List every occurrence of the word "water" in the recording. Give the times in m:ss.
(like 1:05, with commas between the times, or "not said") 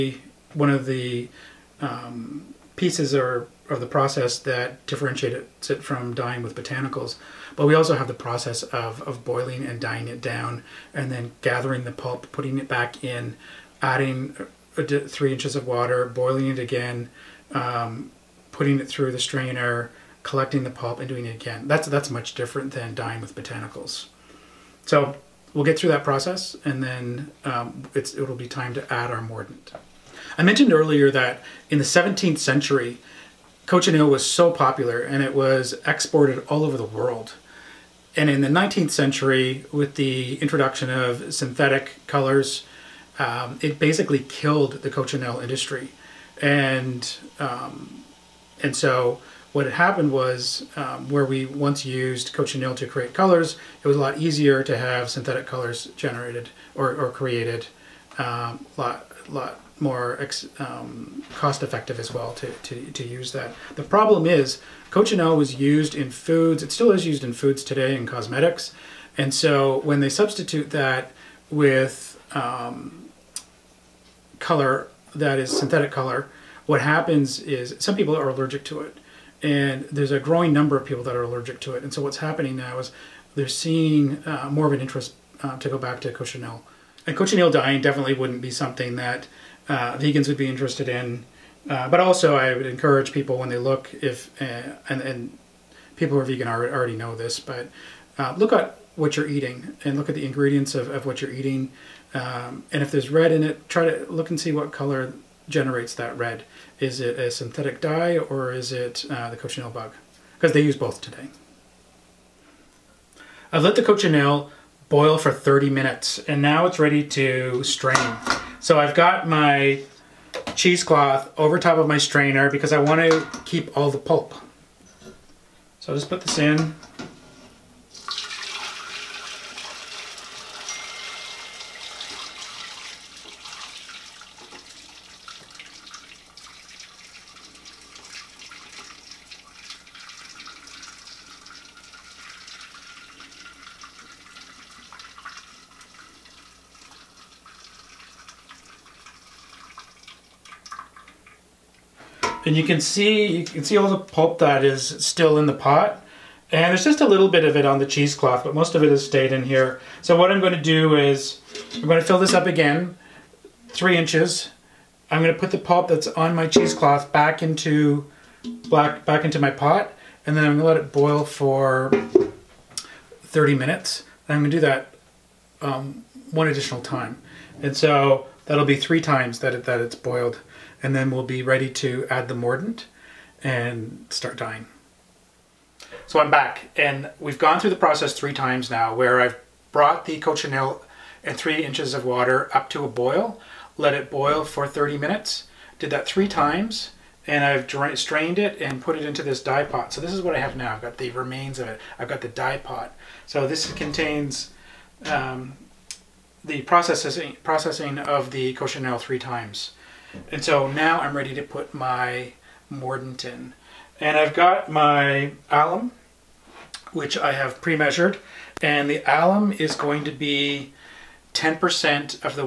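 0:15, 3:12.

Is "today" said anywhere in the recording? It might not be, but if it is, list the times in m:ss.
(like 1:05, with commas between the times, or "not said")
1:07, 1:51.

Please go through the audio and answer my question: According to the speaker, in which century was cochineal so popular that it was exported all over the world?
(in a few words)
17th century.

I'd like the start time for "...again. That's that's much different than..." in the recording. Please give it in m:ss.
0:21.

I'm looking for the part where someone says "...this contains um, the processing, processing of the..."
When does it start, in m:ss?
3:23.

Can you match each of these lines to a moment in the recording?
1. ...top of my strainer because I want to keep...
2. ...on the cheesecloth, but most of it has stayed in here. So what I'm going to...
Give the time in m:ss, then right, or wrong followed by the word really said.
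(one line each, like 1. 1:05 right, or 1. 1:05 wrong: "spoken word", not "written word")
1. 2:01 right
2. 2:37 right.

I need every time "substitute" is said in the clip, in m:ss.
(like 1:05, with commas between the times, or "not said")
1:10.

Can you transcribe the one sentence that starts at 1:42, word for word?
Um, and if there's red in it, try to look and see what color generates that red.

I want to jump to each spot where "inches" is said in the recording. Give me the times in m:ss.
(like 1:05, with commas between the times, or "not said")
0:15, 2:43, 3:11.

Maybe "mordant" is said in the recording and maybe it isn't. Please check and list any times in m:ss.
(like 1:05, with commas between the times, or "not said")
0:29, 3:02, 3:32.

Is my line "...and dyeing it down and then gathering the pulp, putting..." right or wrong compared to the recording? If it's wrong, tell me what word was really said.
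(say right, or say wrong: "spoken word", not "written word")
right.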